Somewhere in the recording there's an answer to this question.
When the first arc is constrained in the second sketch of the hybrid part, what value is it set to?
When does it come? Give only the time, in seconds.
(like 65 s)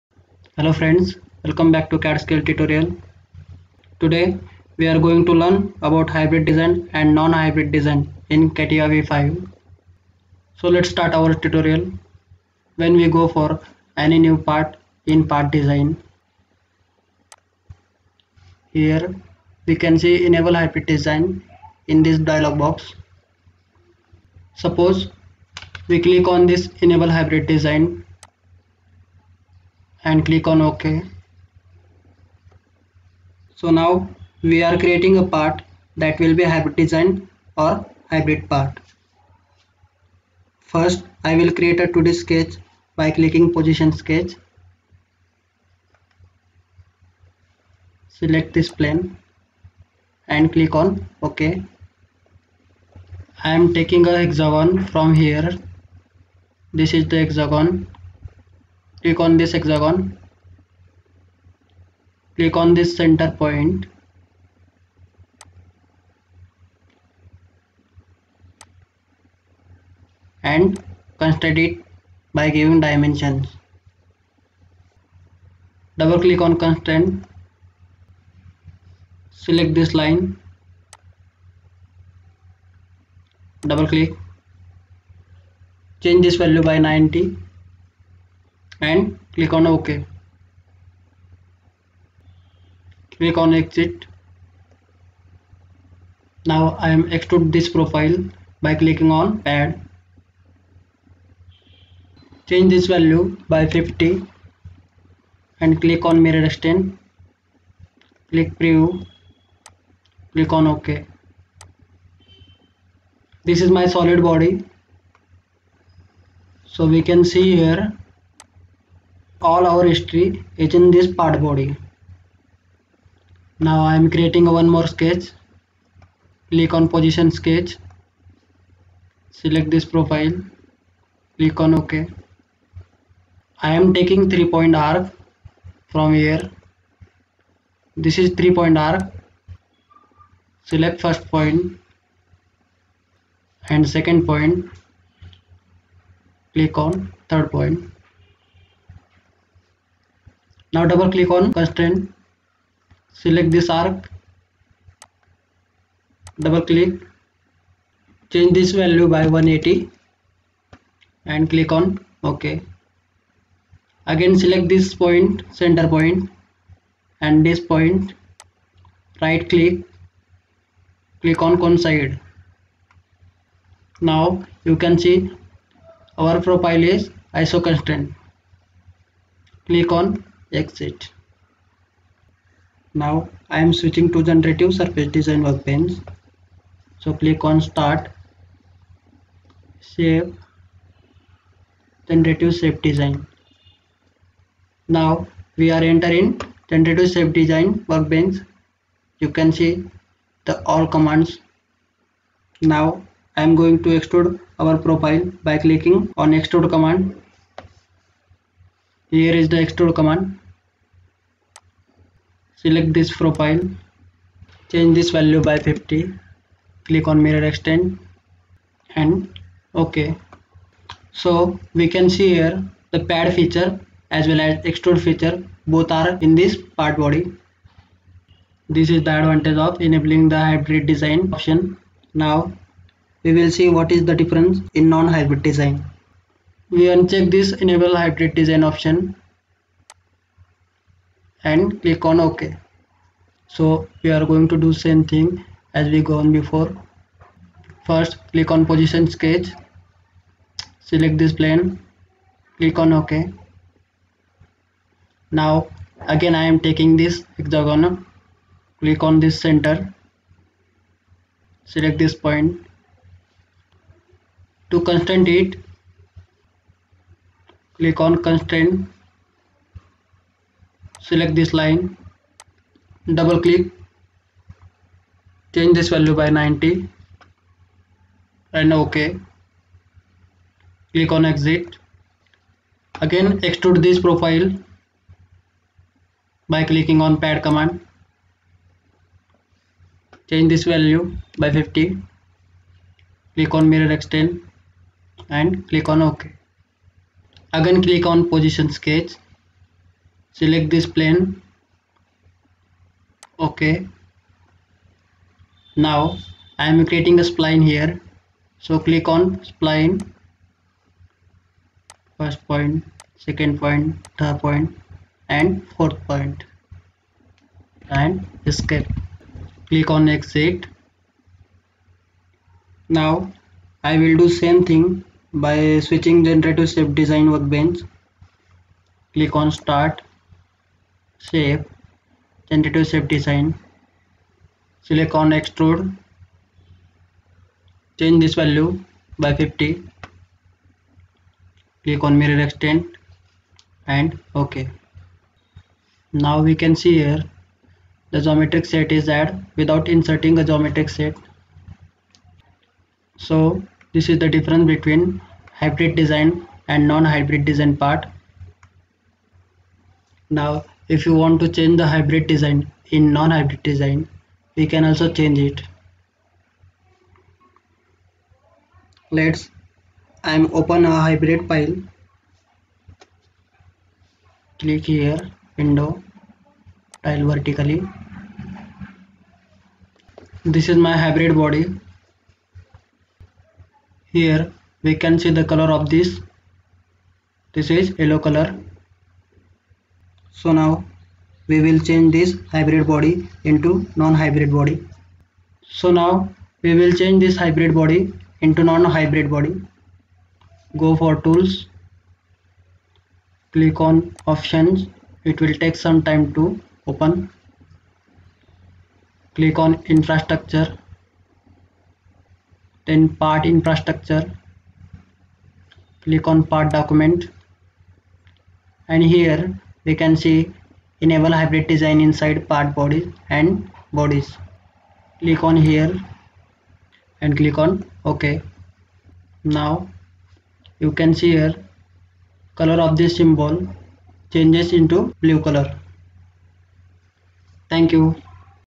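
159 s.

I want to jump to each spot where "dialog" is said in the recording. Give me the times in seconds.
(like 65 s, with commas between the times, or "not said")
22 s.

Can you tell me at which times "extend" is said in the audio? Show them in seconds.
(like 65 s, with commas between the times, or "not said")
106 s, 217 s, 293 s, 342 s.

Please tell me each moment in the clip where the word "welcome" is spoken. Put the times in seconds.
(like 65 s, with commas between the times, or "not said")
1 s.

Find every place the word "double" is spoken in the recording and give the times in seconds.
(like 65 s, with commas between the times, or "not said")
75 s, 83 s, 150 s, 156 s, 273 s.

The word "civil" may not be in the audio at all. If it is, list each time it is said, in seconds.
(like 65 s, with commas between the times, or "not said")
not said.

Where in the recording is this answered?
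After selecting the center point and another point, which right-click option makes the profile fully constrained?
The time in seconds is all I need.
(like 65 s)
171 s.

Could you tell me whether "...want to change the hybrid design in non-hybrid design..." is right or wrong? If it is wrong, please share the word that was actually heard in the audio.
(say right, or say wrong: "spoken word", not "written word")
right.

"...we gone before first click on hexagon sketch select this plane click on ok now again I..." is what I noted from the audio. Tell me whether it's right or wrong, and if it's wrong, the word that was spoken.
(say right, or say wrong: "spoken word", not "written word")
wrong: "position", not "hexagon".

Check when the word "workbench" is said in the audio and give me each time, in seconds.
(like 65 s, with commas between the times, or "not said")
185 s, 197 s, 327 s.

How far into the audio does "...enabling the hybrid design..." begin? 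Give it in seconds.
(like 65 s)
229 s.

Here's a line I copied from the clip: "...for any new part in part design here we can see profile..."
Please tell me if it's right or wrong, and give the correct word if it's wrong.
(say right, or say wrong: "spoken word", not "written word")
wrong: "enable", not "profile".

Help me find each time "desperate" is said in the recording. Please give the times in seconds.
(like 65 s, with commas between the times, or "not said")
not said.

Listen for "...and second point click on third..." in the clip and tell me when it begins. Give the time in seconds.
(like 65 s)
143 s.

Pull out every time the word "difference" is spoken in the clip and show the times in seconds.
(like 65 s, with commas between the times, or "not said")
234 s, 354 s.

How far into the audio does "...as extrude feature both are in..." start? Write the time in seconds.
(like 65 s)
224 s.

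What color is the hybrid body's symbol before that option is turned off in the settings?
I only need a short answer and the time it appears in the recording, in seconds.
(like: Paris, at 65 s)
Yellow, at 388 s.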